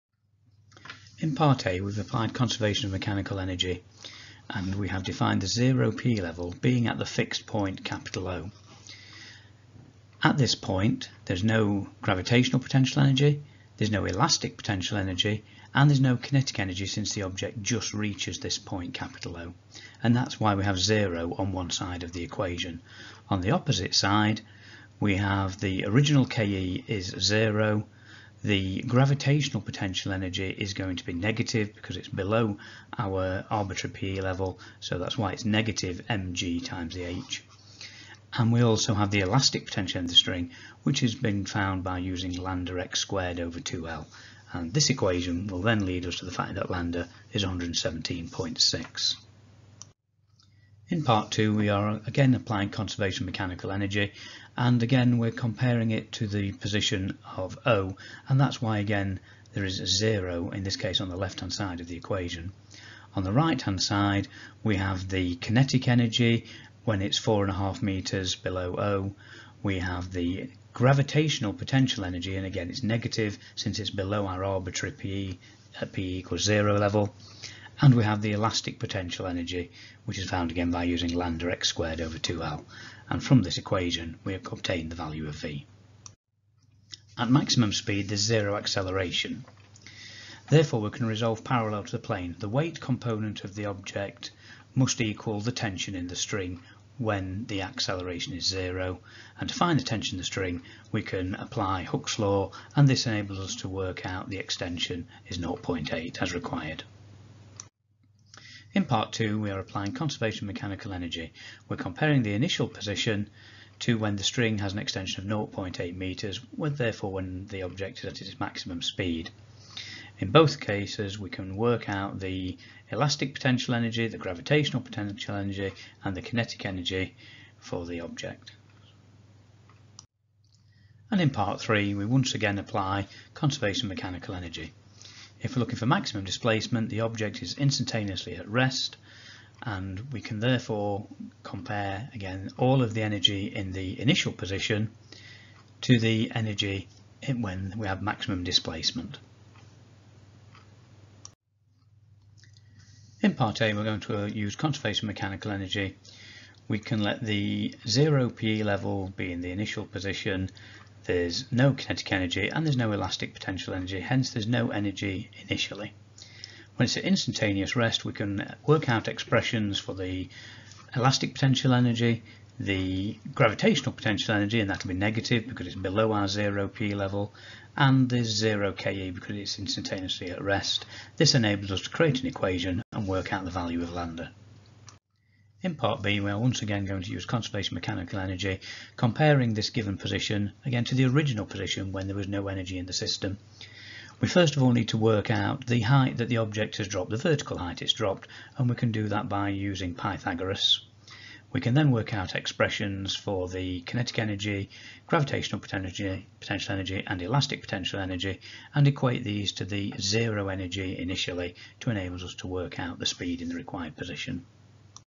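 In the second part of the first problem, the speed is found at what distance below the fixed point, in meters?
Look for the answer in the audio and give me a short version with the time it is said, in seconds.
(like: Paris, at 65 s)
4.5, at 67 s.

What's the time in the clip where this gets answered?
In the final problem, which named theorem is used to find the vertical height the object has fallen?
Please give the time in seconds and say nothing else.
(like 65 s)
199 s.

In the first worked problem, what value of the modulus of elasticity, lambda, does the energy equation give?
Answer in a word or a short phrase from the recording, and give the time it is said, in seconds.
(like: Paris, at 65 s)
117.6, at 47 s.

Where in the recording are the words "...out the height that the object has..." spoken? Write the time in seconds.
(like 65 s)
195 s.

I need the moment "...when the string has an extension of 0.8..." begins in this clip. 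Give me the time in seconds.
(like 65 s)
113 s.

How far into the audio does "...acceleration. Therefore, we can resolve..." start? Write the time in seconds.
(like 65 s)
88 s.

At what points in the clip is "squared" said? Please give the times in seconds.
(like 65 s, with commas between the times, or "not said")
42 s, 81 s.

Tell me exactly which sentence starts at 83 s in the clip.
And from this equation, we have obtained the value of V.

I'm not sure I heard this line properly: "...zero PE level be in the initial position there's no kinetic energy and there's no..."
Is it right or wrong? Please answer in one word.
right.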